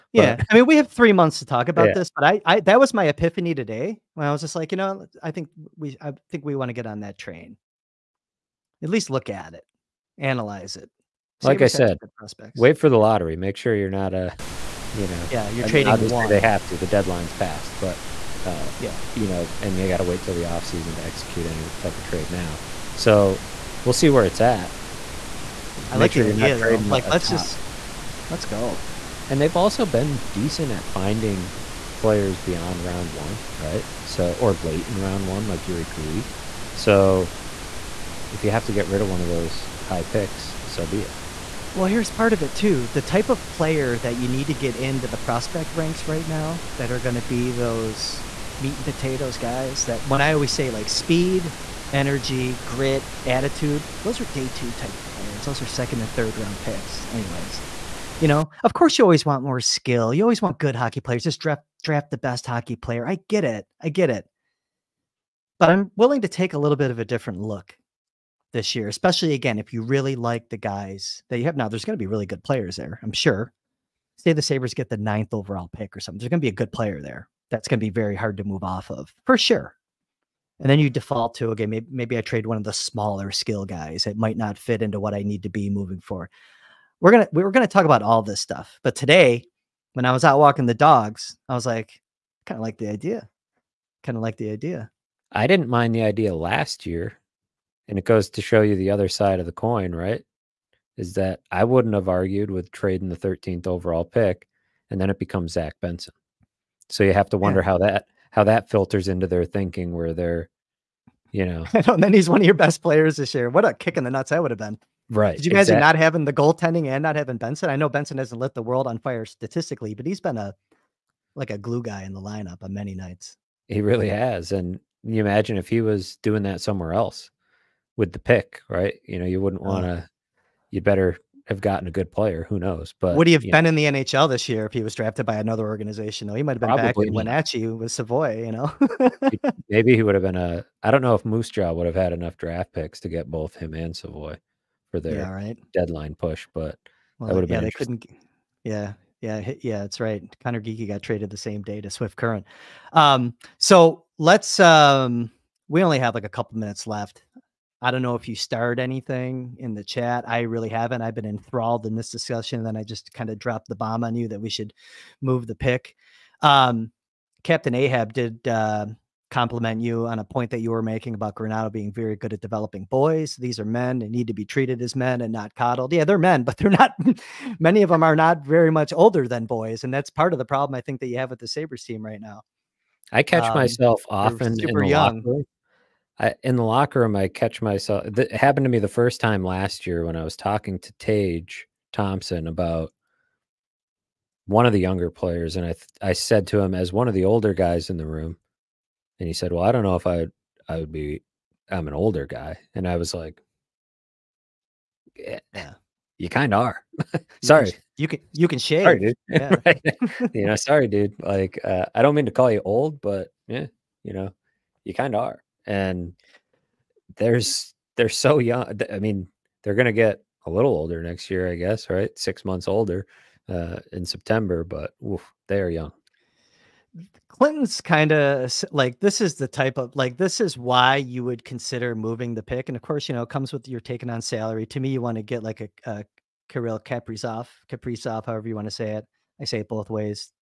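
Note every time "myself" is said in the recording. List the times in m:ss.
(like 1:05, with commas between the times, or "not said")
3:03, 3:07.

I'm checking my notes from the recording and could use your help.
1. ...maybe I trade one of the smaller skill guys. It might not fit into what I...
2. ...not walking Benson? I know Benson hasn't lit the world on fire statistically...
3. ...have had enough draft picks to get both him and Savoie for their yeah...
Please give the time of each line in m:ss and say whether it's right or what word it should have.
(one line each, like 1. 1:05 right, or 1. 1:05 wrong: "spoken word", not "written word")
1. 1:21 right
2. 1:57 wrong: "having", not "walking"
3. 2:21 right.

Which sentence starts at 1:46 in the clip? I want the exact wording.
So you have to wonder yeah.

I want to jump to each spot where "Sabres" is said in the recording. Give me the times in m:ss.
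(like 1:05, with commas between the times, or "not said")
1:14, 3:01.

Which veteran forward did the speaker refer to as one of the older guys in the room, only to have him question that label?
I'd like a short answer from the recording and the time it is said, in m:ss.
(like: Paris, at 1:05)
Tage Thompson, at 3:10.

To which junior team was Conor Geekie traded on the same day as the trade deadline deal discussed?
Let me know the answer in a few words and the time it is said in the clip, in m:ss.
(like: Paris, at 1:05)
Swift Current, at 2:31.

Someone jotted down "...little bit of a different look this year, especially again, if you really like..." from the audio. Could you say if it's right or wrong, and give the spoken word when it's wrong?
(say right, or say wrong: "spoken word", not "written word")
right.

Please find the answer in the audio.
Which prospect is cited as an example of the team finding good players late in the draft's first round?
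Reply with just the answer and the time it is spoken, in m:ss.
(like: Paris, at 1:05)
Jiri Kulich, at 0:35.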